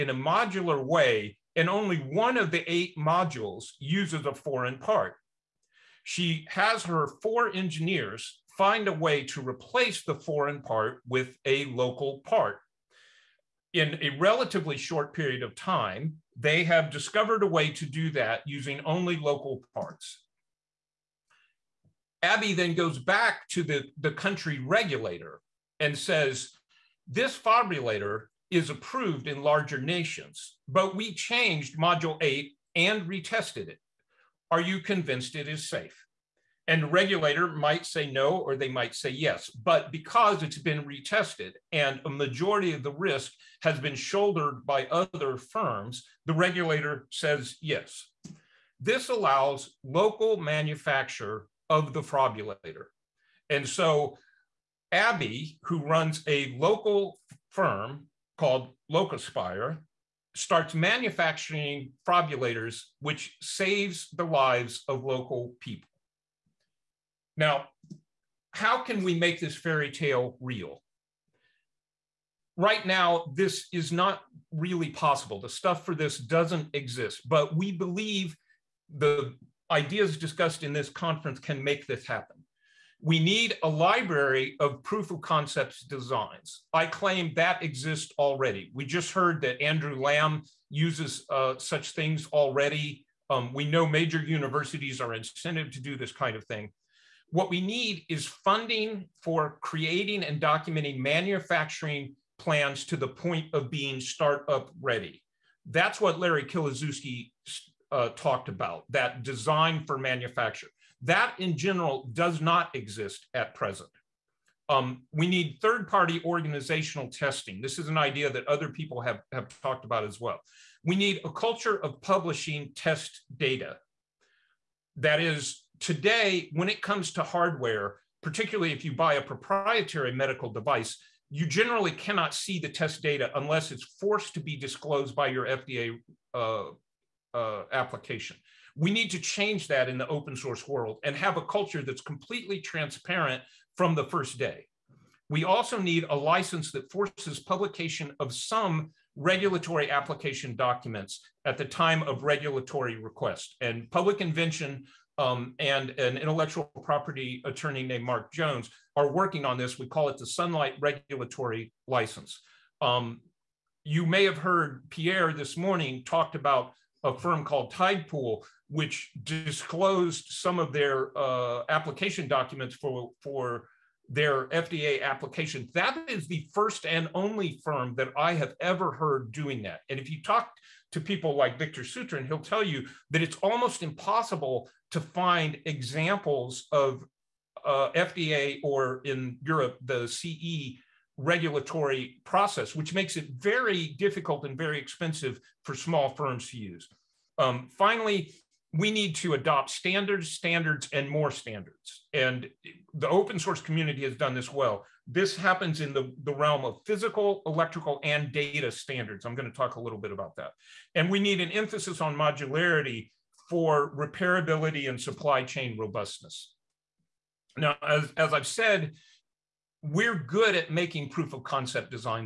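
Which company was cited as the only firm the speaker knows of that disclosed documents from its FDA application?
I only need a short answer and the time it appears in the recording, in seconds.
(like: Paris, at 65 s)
Tidepool, at 167 s.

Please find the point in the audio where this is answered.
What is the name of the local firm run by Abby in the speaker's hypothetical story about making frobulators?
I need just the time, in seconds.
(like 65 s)
58 s.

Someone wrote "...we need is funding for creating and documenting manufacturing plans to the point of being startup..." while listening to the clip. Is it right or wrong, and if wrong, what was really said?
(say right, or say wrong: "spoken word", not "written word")
right.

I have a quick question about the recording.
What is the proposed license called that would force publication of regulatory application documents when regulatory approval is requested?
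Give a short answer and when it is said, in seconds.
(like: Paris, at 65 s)
Sunlight Regulatory License, at 160 s.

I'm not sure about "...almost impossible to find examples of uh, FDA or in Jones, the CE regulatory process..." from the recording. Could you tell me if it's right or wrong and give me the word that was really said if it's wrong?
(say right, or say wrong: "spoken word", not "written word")
wrong: "Europe", not "Jones".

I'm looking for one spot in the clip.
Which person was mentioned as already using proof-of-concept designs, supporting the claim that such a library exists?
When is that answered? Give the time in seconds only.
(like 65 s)
89 s.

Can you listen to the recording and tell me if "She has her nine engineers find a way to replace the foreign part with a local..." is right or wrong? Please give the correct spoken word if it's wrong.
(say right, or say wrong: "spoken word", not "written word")
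wrong: "four", not "nine".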